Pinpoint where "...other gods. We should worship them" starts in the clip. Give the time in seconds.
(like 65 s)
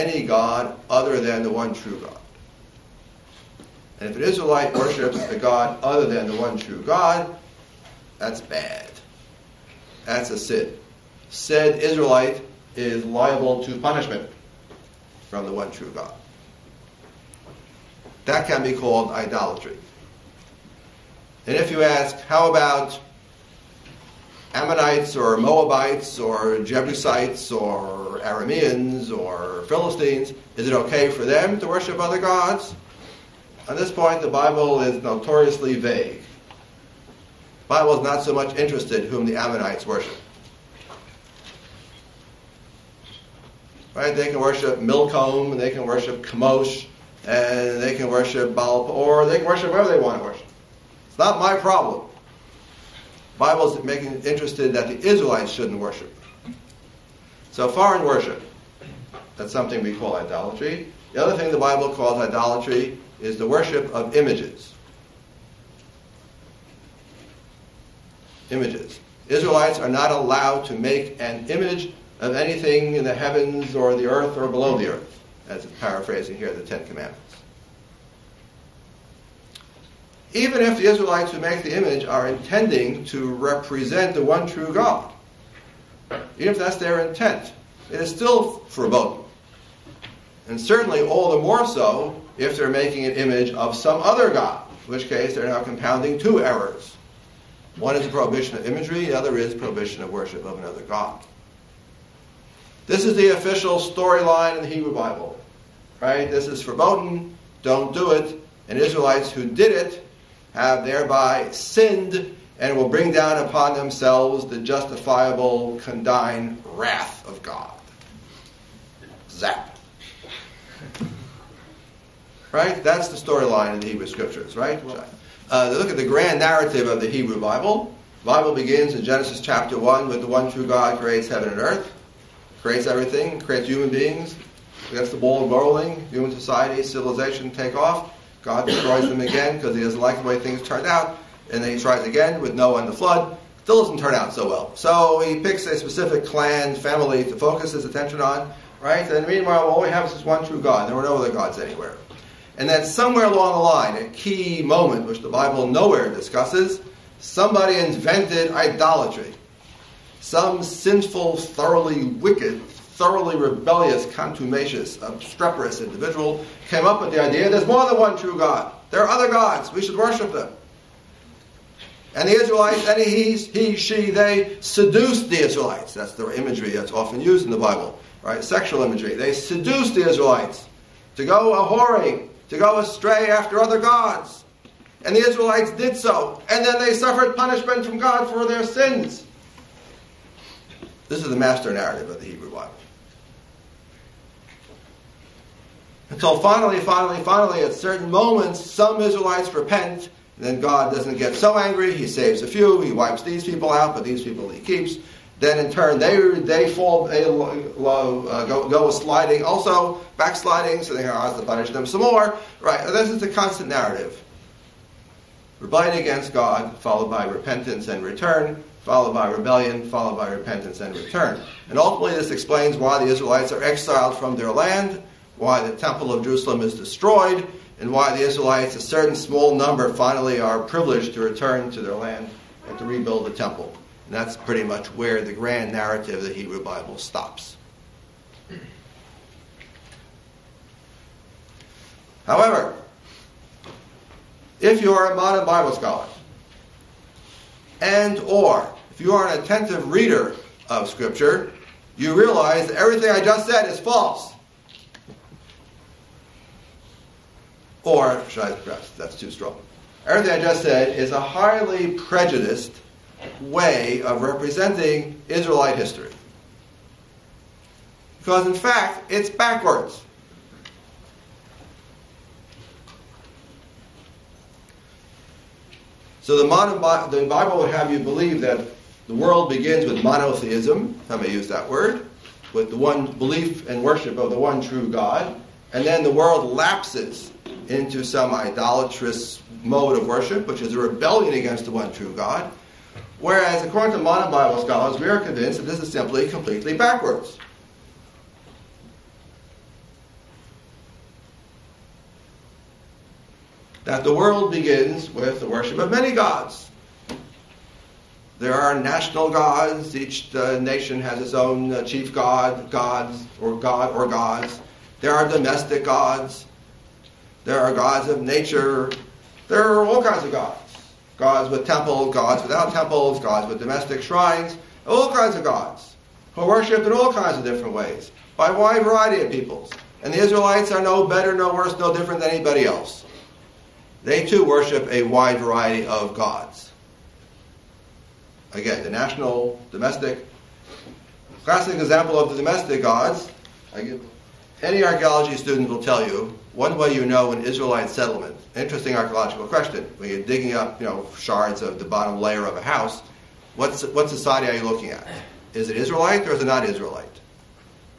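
169 s.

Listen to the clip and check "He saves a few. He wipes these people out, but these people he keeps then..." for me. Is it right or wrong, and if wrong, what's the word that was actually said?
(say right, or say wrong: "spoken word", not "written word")
right.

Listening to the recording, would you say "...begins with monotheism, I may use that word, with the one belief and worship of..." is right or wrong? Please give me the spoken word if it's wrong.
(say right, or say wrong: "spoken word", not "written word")
right.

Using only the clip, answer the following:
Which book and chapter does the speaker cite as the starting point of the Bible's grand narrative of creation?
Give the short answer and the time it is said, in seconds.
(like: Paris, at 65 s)
Genesis chapter 1, at 129 s.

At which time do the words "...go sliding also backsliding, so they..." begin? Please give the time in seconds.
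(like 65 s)
208 s.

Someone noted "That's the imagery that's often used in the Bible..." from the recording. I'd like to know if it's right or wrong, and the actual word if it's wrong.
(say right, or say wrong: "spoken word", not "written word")
right.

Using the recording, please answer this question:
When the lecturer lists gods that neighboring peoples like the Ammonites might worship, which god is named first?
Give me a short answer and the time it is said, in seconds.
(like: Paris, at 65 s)
Milcom, at 44 s.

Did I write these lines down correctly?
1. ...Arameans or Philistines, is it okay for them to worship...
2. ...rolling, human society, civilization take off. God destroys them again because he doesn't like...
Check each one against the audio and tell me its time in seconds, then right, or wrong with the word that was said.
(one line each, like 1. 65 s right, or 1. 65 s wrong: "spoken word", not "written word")
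1. 28 s right
2. 135 s right.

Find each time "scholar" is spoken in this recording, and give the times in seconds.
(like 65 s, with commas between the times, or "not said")
245 s, 294 s.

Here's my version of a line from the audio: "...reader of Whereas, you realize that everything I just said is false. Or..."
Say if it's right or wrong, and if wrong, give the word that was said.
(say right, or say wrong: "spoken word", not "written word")
wrong: "Scripture", not "Whereas".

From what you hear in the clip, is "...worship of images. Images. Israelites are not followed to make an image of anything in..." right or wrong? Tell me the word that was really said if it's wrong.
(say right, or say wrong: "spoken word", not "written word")
wrong: "allowed", not "followed".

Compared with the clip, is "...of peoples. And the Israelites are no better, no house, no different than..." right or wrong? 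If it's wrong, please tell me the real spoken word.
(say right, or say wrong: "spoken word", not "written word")
wrong: "worse", not "house".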